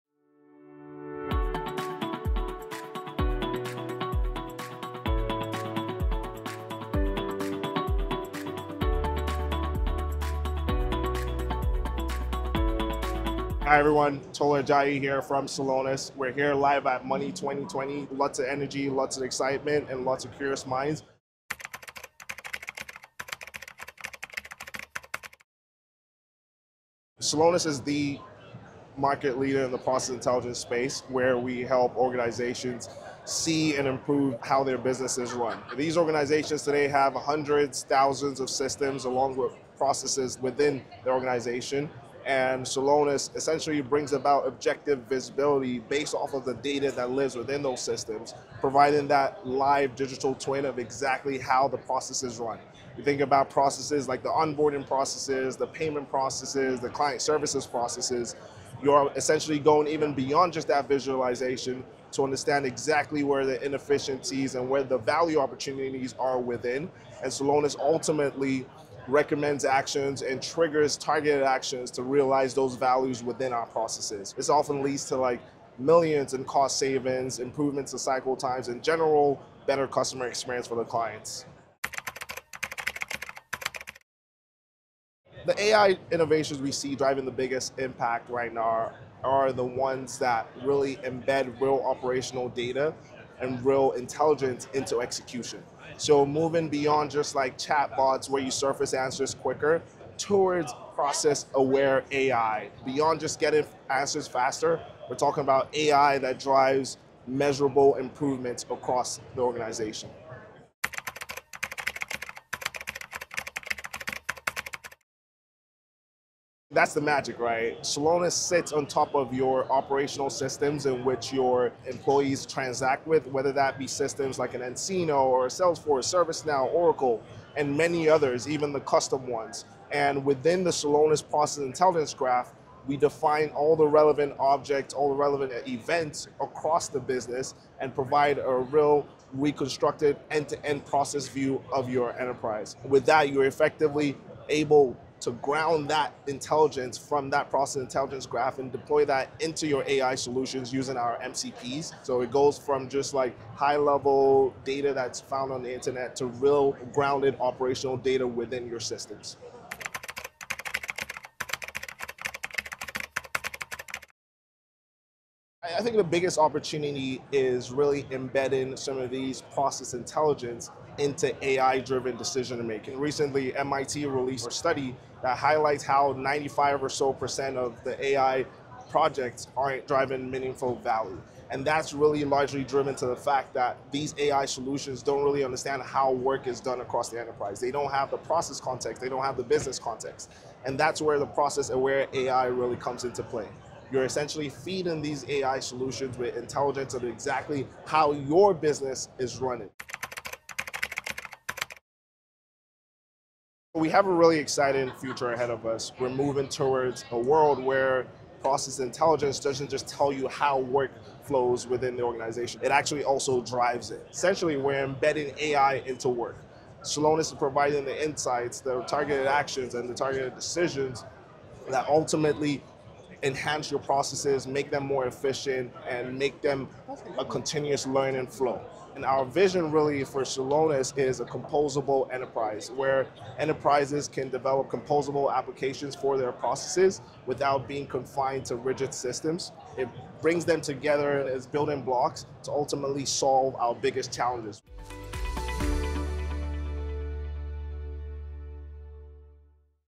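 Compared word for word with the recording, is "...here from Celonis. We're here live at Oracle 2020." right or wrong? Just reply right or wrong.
wrong.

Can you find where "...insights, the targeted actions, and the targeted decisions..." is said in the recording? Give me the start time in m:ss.
3:38.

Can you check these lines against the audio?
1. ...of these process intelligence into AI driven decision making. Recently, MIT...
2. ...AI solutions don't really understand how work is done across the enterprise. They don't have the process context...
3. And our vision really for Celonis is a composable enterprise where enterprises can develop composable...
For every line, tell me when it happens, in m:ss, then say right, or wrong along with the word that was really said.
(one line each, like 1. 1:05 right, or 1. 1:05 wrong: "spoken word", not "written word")
1. 2:48 right
2. 3:04 right
3. 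3:48 right.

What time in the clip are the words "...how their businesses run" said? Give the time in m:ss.
0:34.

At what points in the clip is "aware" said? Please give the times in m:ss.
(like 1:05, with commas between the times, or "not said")
1:41, 3:11.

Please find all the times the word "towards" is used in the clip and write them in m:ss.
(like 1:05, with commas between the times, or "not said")
1:40, 3:26.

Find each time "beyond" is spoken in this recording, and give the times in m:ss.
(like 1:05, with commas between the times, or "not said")
1:00, 1:36, 1:42.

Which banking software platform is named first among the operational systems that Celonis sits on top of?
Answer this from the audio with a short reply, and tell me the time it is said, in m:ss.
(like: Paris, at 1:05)
nCino, at 2:04.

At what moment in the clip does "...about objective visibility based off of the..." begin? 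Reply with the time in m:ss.
0:44.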